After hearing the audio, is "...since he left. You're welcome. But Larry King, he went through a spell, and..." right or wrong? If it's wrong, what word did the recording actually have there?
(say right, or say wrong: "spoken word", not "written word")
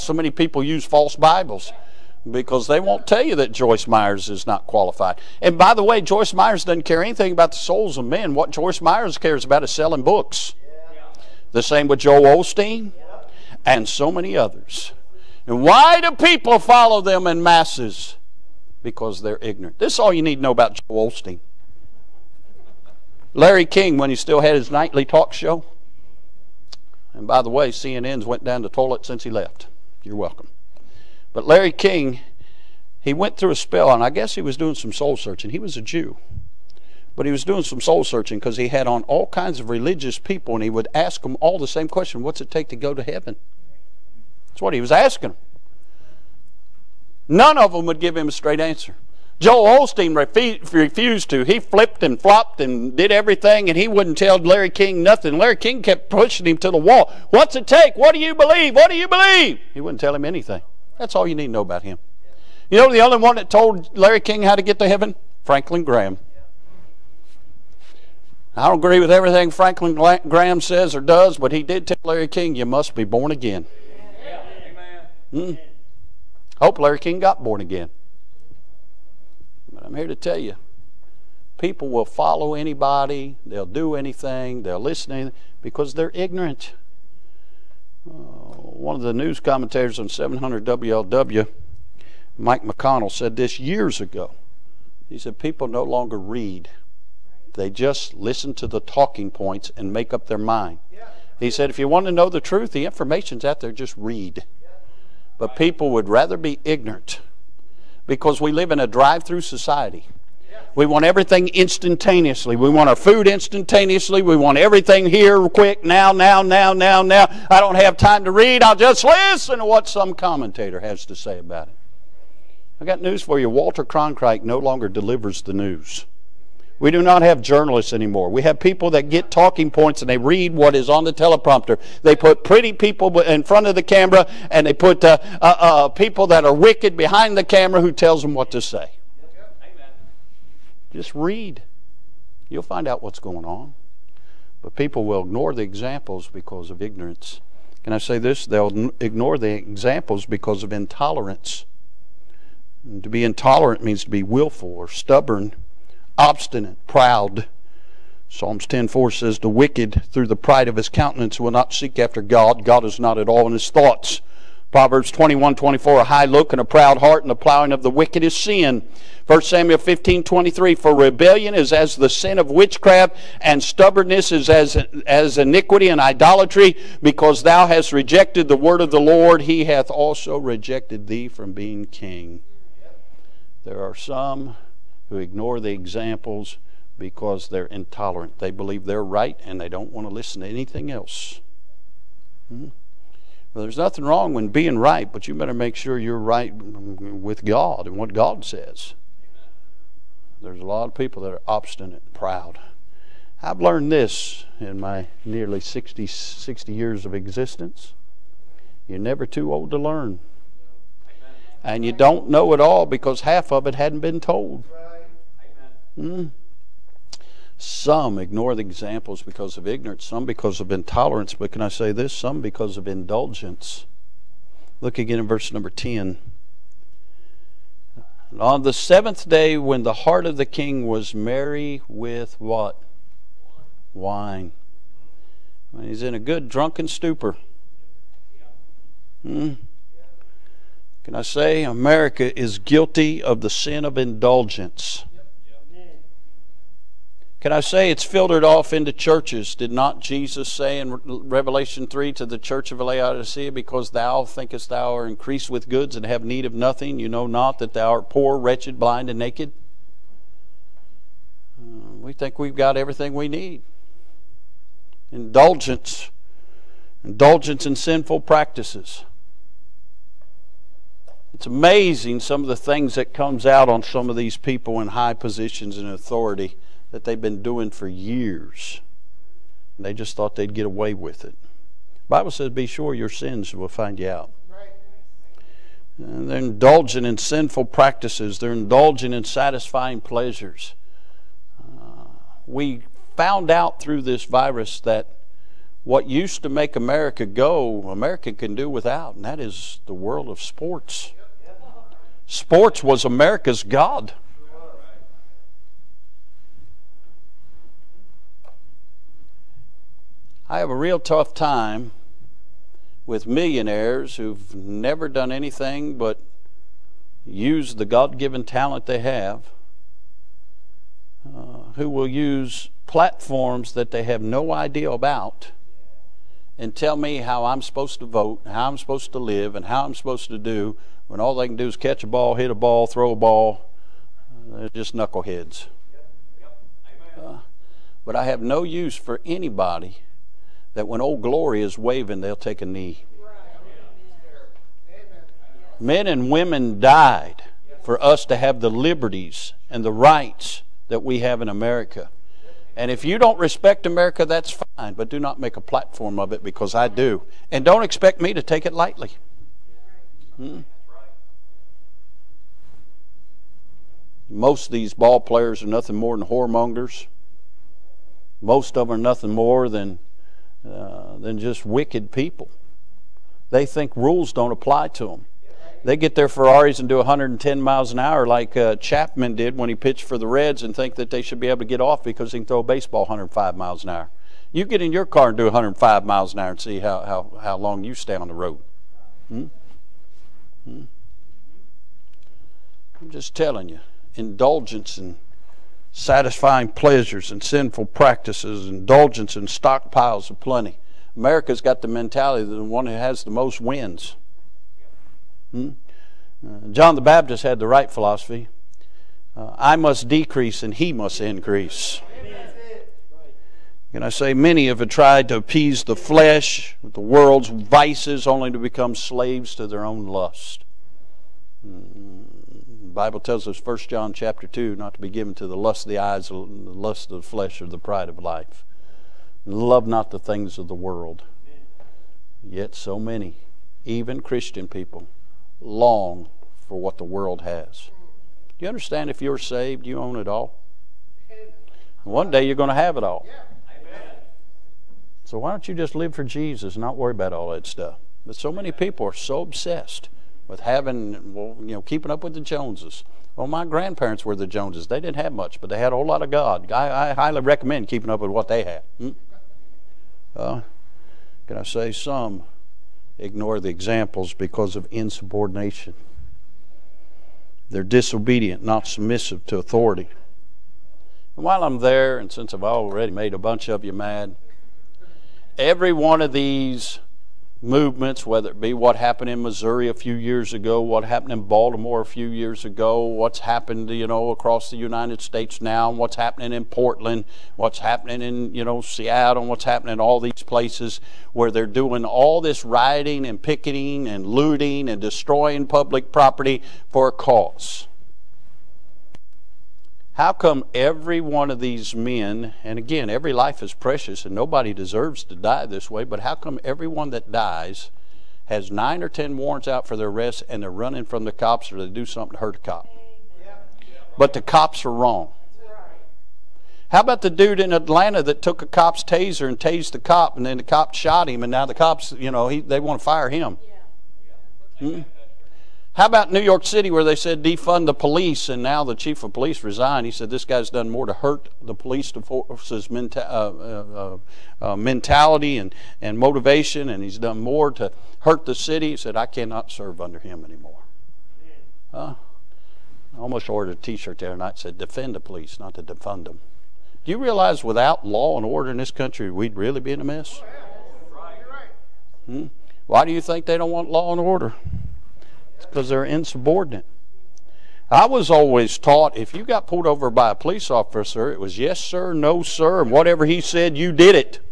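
right.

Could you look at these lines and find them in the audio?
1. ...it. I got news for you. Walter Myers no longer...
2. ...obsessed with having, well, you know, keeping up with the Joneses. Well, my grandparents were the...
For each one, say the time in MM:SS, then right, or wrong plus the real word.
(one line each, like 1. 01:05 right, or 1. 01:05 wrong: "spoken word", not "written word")
1. 02:01 wrong: "Cronkite", not "Myers"
2. 07:29 right.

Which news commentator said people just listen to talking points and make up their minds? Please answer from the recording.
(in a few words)
Mike McConnell.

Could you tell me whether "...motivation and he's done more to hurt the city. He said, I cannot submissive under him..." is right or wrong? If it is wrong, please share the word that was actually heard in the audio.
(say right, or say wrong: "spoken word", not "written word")
wrong: "serve", not "submissive".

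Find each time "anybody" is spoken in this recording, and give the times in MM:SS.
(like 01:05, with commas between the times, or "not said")
01:22, 05:39.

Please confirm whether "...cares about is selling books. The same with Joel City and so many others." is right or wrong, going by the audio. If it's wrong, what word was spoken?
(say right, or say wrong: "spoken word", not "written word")
wrong: "Osteen", not "City".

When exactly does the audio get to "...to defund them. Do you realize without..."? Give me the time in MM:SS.
09:05.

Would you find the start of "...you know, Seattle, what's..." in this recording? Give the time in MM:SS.
08:08.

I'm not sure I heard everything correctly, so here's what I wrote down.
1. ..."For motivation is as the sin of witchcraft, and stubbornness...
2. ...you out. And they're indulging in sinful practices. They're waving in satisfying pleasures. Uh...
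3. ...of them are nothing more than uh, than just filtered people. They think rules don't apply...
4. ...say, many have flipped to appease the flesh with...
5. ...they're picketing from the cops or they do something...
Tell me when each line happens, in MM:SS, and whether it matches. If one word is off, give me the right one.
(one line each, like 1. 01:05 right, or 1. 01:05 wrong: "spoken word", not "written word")
1. 02:50 wrong: "rebellion", not "motivation"
2. 04:43 wrong: "indulging", not "waving"
3. 06:08 wrong: "wicked", not "filtered"
4. 06:54 wrong: "tried", not "flipped"
5. 08:30 wrong: "running", not "picketing".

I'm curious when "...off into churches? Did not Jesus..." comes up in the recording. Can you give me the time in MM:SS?
04:08.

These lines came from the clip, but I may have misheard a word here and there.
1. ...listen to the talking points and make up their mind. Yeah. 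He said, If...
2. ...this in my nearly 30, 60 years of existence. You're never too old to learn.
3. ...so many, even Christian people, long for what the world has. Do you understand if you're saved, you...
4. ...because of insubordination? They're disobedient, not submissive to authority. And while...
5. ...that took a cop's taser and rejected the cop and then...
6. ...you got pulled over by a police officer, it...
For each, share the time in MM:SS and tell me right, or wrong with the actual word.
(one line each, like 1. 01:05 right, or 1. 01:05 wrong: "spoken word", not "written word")
1. 01:38 right
2. 03:23 wrong: "60", not "30"
3. 07:12 right
4. 07:44 right
5. 08:38 wrong: "tased", not "rejected"
6. 09:19 right.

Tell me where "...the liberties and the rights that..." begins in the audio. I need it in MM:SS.
05:48.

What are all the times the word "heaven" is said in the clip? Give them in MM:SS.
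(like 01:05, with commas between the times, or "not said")
00:43, 01:04.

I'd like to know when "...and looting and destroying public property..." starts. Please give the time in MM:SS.
08:14.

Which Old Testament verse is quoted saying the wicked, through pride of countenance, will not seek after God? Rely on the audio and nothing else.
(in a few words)
Psalms 10:4.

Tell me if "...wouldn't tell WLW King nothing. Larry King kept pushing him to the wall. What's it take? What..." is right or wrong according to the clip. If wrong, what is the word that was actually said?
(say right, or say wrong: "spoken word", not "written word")
wrong: "Larry", not "WLW".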